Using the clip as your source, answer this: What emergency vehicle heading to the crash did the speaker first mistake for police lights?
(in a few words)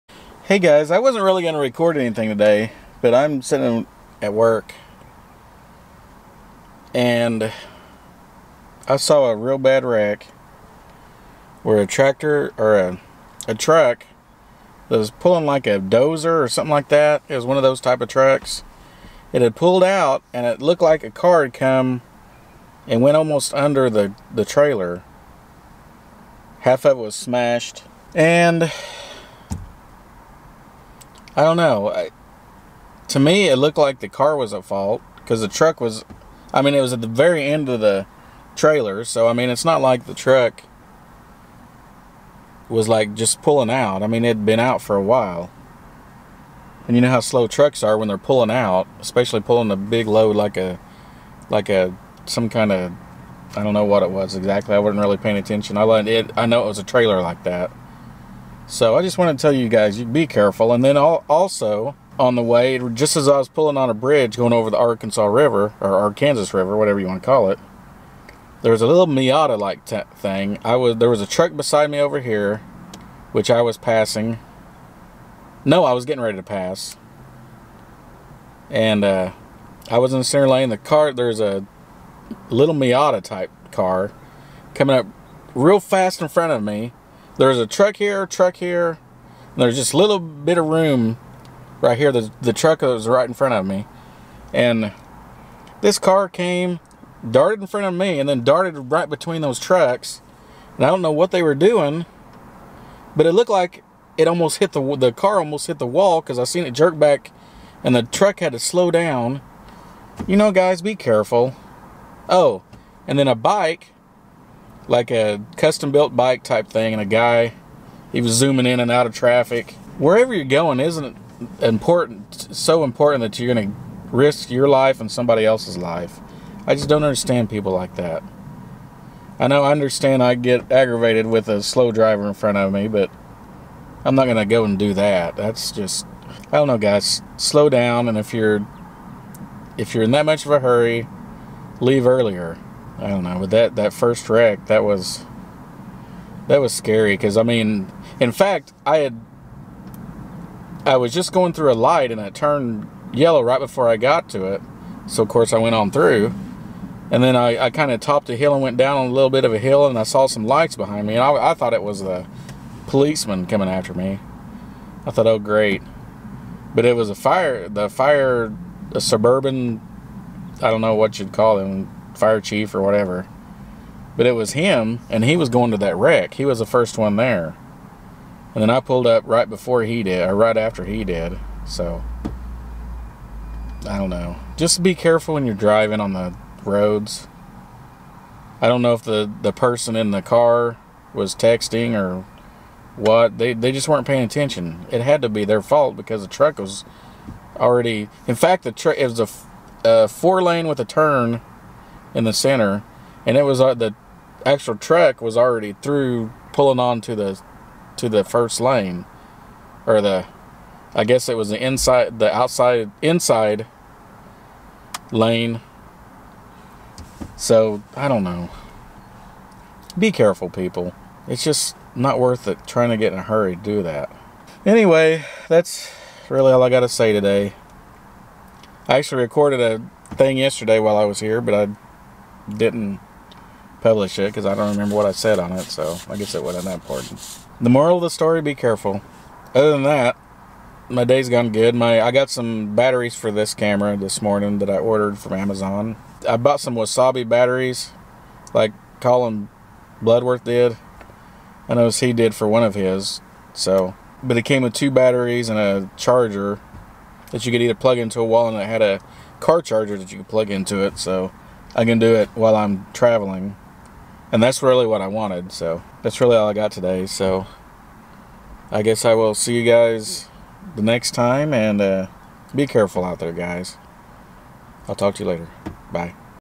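Suburban.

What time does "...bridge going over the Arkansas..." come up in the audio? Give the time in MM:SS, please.
01:03.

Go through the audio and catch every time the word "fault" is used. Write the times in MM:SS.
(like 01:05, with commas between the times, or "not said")
00:34, 03:15.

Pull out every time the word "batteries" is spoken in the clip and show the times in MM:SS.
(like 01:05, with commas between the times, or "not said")
04:02, 04:07, 04:14.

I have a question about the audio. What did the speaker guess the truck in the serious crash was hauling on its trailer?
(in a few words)
A dozer.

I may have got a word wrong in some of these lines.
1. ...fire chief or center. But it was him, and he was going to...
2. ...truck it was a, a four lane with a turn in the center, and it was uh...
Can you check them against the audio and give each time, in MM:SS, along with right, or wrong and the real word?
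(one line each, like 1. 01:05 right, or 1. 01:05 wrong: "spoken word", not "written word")
1. 02:52 wrong: "whatever", not "center"
2. 03:18 right.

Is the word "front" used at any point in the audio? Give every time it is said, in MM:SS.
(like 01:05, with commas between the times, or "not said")
01:26, 01:33, 01:37, 02:12.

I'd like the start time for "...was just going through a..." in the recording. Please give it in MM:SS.
02:30.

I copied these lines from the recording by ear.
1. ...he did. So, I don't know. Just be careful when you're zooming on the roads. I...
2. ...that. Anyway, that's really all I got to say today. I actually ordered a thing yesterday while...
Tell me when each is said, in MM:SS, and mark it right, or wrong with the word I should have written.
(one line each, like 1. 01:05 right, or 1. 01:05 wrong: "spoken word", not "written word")
1. 03:00 wrong: "driving", not "zooming"
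2. 03:43 wrong: "recorded", not "ordered".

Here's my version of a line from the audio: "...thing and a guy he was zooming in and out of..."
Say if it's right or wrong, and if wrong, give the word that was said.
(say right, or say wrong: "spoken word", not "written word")
right.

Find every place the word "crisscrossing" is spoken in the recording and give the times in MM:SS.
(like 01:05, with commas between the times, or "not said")
not said.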